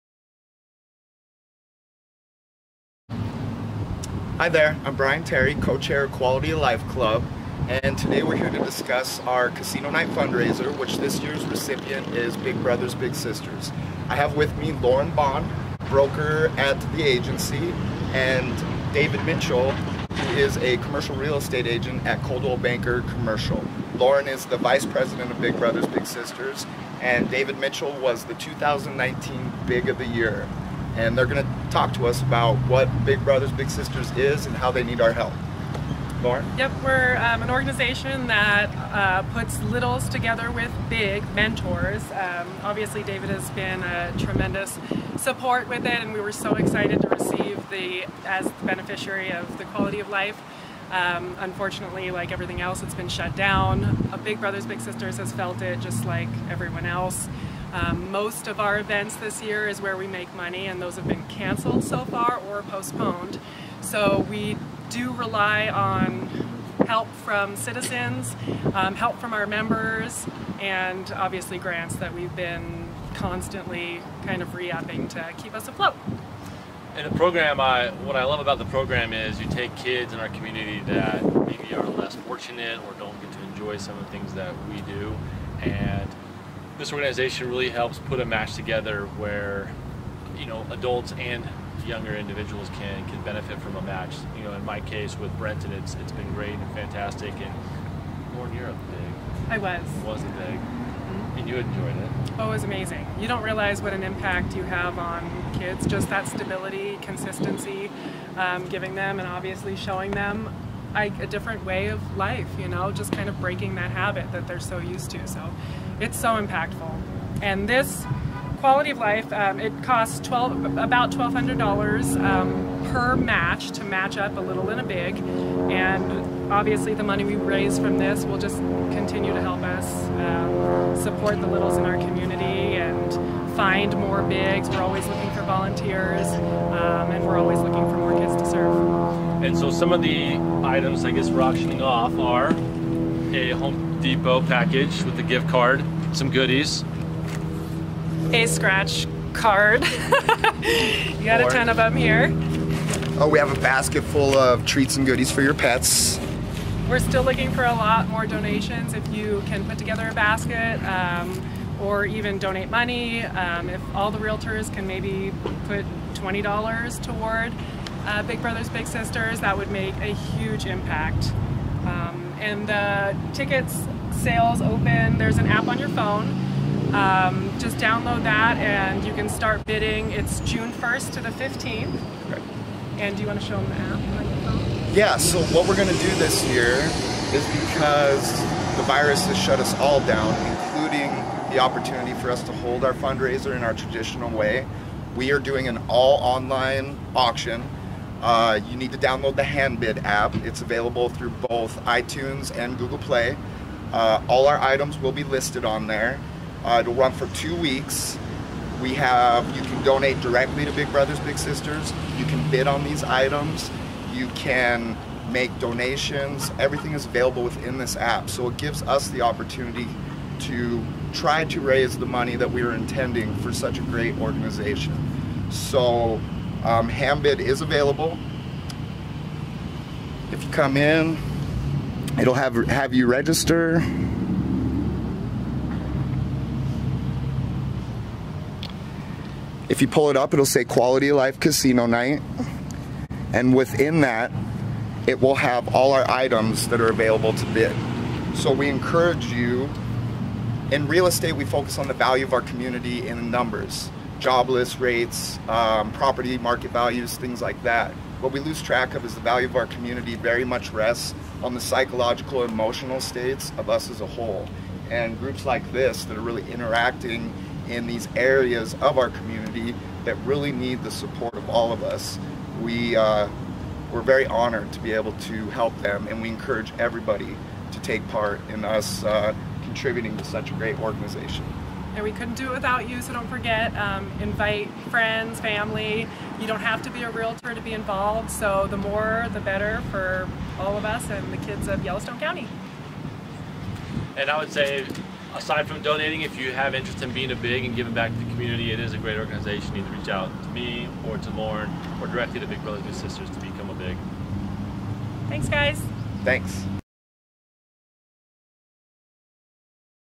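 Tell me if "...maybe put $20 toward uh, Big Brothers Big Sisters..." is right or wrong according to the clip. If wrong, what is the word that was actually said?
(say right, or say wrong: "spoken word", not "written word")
right.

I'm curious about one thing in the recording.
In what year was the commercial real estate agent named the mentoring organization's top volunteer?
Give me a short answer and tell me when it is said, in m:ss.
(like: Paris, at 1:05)
2019, at 0:28.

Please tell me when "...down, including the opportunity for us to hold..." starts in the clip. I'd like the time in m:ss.
3:10.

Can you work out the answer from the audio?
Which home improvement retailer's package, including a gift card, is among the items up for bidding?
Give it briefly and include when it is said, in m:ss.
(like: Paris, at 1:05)
Home Depot, at 2:23.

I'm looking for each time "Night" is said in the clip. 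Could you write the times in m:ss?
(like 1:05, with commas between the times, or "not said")
0:09, 4:01.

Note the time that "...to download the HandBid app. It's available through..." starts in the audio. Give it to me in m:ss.
3:18.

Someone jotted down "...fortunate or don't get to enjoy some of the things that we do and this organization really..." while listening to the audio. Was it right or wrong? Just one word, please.
right.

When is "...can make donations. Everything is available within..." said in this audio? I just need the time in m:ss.
3:34.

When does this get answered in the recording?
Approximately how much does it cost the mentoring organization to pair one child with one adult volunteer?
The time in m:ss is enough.
2:01.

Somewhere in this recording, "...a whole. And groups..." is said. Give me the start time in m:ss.
4:23.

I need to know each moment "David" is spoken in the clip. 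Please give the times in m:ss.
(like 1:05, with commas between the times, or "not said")
0:18, 0:27, 0:43.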